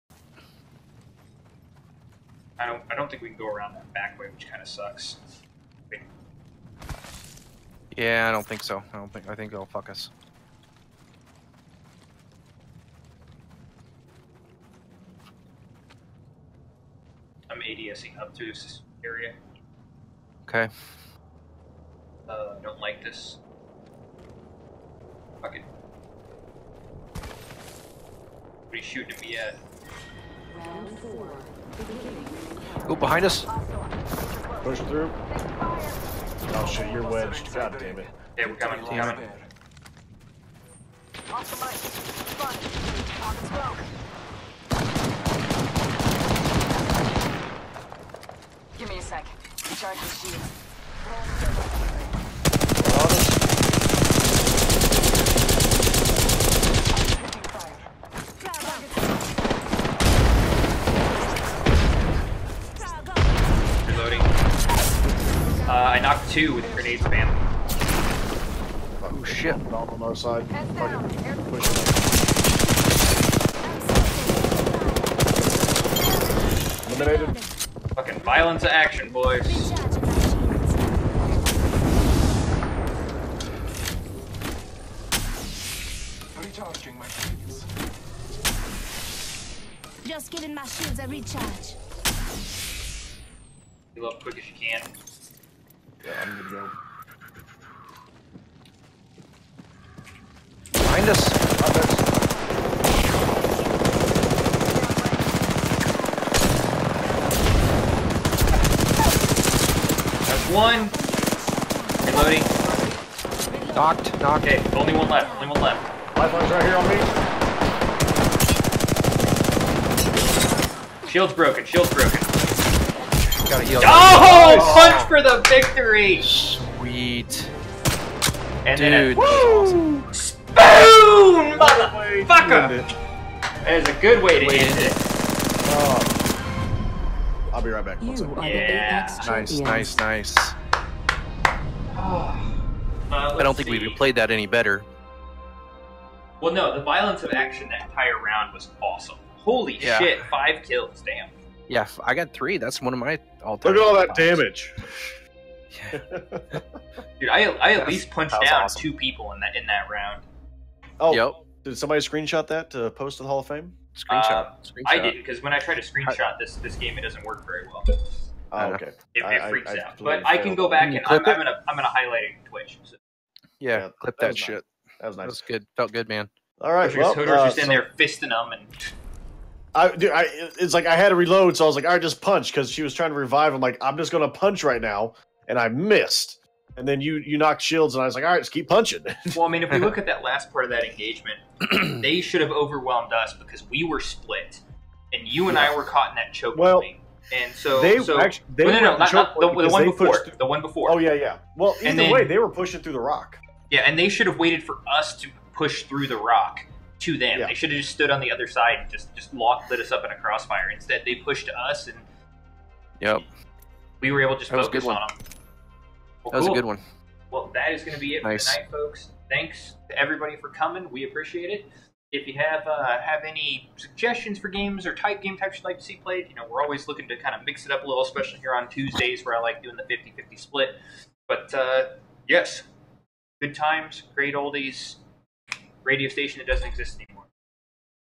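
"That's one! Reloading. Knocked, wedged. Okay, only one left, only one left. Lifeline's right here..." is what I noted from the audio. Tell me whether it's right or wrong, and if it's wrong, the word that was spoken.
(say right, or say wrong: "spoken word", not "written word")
wrong: "knocked", not "wedged".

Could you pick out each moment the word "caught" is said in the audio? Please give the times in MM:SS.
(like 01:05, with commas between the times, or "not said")
03:15.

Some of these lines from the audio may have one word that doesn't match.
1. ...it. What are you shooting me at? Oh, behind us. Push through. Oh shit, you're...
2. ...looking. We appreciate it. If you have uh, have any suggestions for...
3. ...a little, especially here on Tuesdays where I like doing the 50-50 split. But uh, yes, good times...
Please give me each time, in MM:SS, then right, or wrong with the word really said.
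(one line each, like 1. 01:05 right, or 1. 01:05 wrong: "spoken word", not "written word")
1. 00:25 right
2. 03:40 wrong: "coming", not "looking"
3. 03:47 right.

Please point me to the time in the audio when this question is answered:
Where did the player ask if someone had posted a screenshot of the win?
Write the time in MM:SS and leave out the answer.
02:43.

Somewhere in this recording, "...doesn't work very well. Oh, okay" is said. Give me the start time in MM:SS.
02:47.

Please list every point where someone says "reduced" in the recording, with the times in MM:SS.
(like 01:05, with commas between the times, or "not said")
not said.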